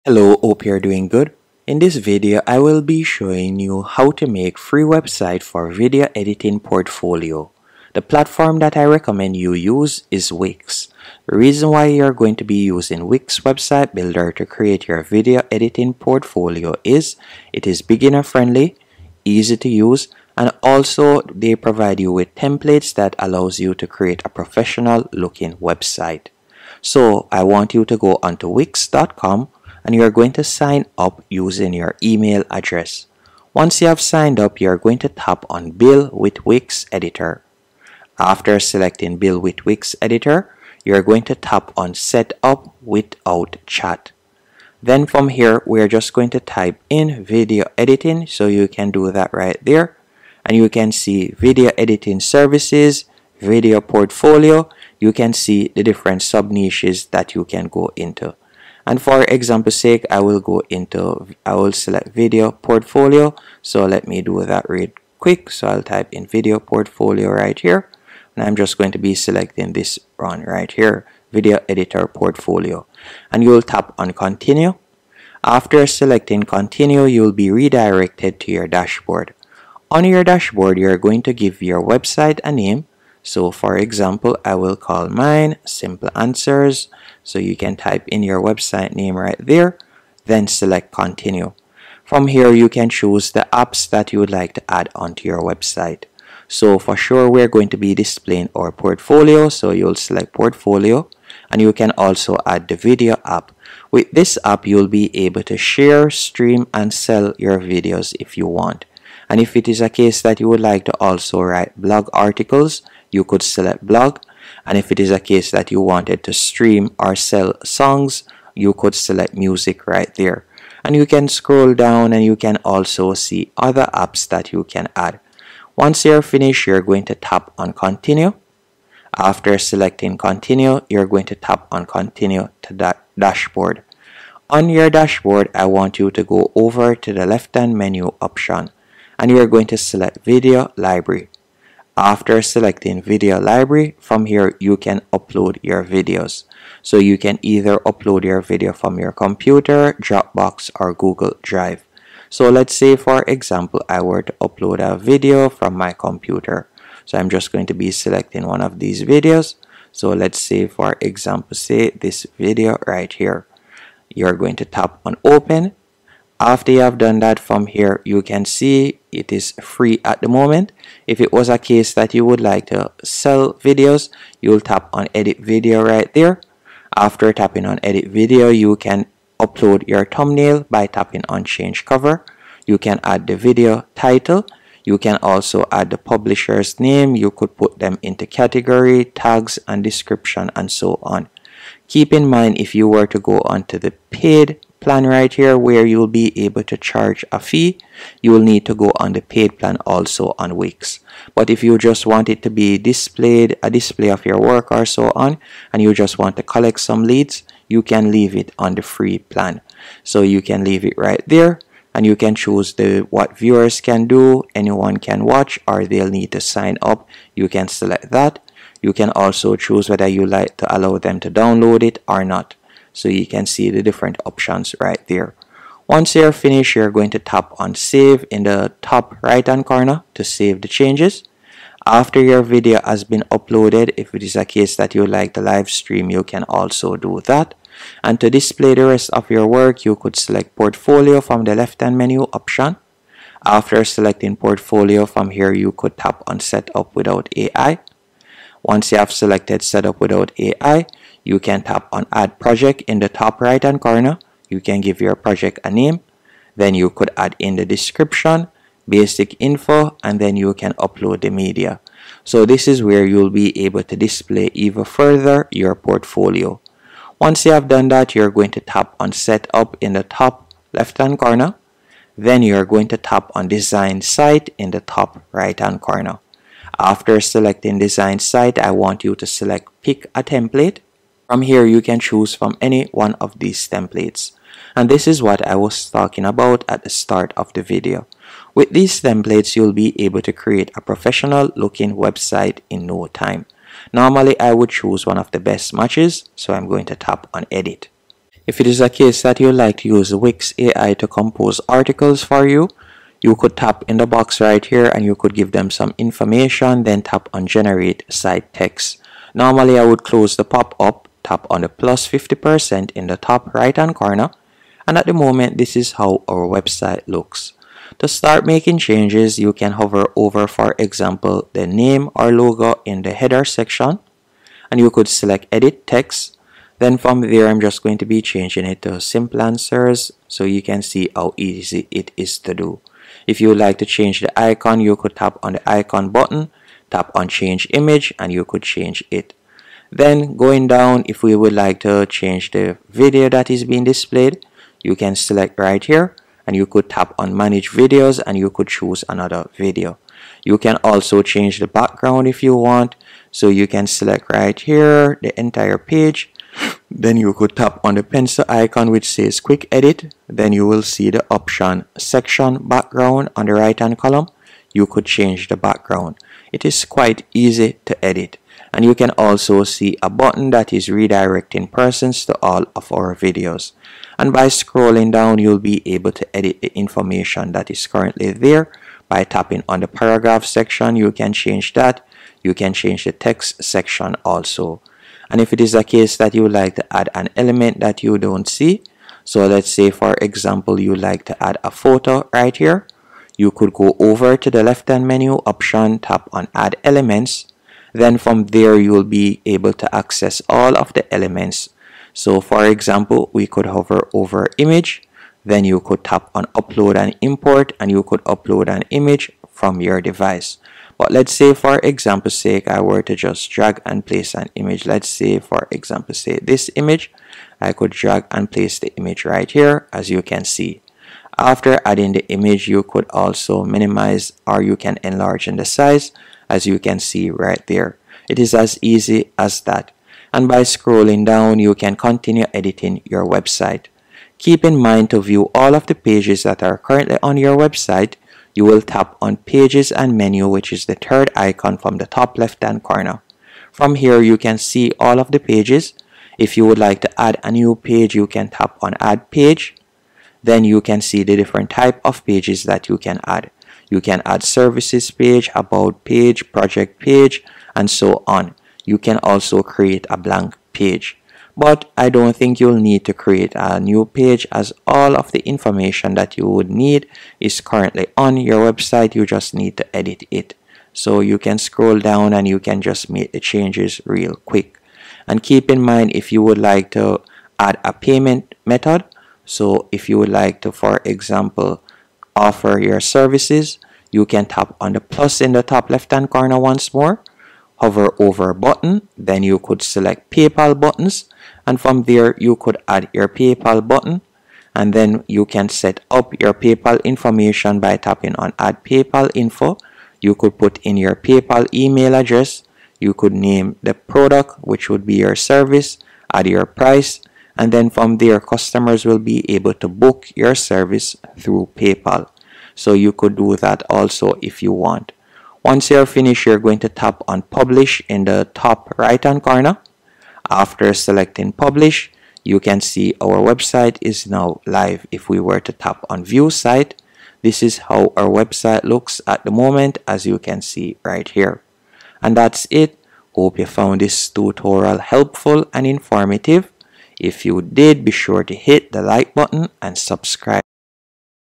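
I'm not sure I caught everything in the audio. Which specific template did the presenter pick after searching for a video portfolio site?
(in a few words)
video editor portfolio.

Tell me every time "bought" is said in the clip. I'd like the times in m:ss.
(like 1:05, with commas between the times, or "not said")
not said.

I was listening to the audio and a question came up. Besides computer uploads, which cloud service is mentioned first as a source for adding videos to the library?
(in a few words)
Dropbox.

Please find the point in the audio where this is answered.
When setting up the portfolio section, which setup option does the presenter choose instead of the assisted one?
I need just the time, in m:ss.
4:06.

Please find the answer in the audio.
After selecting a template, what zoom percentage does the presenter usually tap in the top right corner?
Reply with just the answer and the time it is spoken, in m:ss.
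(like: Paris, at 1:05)
50 percent, at 5:12.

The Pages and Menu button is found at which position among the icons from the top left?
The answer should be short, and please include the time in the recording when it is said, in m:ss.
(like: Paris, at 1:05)
third, at 7:20.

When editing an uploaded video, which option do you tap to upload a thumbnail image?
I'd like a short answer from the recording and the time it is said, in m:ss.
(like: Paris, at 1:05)
change cover, at 3:01.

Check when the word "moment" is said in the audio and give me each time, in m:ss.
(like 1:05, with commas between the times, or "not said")
2:50, 5:15, 8:49.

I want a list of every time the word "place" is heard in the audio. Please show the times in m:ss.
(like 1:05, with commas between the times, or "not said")
6:54, 6:58.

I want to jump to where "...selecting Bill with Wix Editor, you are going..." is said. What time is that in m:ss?
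0:38.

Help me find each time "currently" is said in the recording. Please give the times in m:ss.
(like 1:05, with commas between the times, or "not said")
6:17, 7:16, 7:47.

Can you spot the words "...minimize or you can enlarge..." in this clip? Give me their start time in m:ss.
7:03.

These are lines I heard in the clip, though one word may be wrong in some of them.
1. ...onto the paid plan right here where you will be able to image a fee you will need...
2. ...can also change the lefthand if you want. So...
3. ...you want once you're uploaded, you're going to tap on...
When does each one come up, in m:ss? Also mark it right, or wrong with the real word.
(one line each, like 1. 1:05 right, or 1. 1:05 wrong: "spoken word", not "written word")
1. 3:13 wrong: "charge", not "image"
2. 5:50 wrong: "background", not "lefthand"
3. 8:34 wrong: "finished", not "uploaded".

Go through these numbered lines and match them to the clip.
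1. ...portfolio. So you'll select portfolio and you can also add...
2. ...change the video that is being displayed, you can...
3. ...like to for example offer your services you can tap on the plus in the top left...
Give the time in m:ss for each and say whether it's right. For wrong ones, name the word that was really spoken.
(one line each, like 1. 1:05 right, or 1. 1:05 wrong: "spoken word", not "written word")
1. 1:38 right
2. 5:42 right
3. 8:00 right.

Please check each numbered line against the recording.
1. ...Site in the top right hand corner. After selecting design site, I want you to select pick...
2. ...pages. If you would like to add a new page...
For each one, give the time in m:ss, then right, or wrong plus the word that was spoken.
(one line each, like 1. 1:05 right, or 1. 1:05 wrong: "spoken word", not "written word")
1. 4:34 right
2. 7:25 right.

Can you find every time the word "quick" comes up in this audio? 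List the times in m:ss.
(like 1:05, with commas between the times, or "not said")
1:05, 5:59, 7:54.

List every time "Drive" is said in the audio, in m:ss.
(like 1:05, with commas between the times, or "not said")
2:31.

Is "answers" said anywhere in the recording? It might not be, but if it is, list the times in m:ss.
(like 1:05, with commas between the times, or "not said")
1:26, 5:29.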